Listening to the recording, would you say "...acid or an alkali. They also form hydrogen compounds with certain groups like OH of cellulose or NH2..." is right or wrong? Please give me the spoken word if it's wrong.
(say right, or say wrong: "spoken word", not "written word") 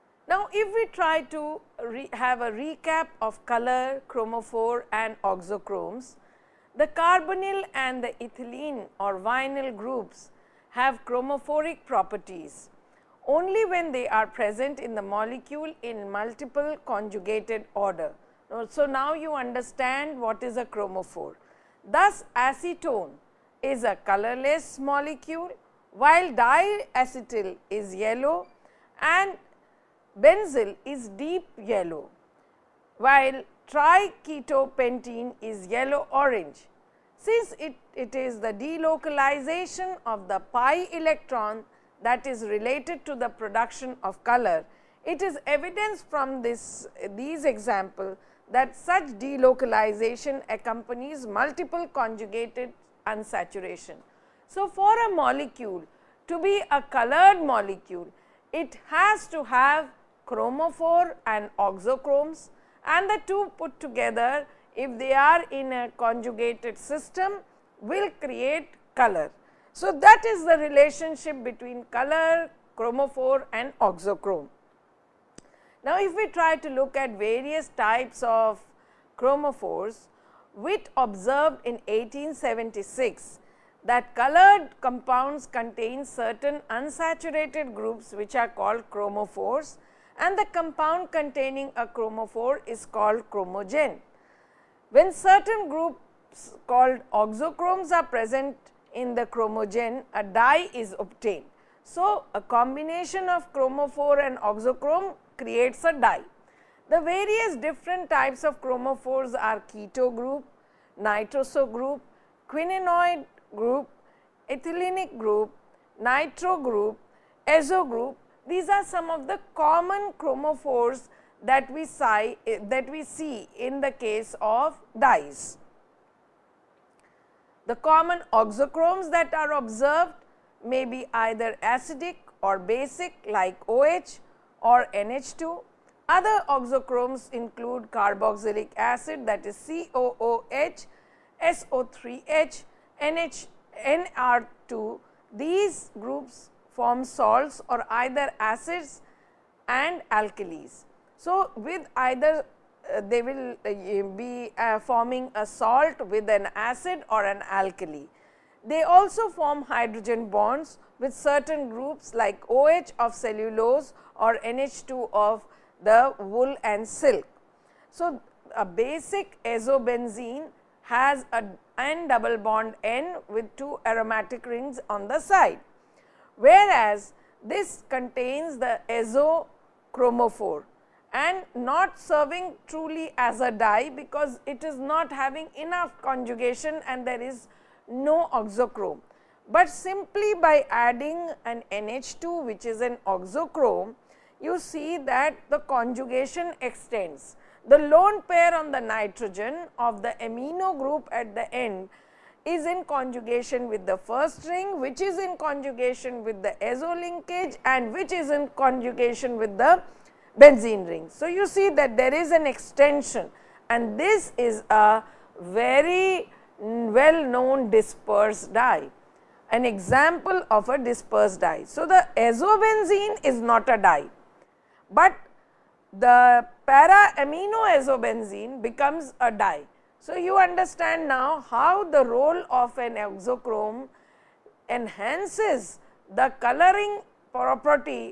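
wrong: "bonds", not "compounds".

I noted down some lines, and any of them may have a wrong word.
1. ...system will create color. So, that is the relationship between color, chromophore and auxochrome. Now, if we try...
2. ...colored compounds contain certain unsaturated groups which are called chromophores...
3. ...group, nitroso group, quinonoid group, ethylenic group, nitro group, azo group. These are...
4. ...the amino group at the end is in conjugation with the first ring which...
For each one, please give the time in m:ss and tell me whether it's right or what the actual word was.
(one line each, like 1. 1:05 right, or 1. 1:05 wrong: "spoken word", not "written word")
1. 1:06 right
2. 1:24 right
3. 1:50 right
4. 3:20 right.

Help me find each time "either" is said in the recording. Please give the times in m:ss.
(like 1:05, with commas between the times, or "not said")
2:11, 2:27, 2:31.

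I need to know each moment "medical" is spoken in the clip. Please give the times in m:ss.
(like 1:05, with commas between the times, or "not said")
not said.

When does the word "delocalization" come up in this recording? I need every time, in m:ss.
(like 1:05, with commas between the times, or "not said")
0:38, 0:49.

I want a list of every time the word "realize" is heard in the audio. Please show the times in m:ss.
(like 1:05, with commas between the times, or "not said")
not said.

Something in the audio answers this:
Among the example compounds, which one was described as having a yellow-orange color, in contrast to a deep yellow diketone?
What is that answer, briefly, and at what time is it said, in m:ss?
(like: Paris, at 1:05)
Triketopentane, at 0:33.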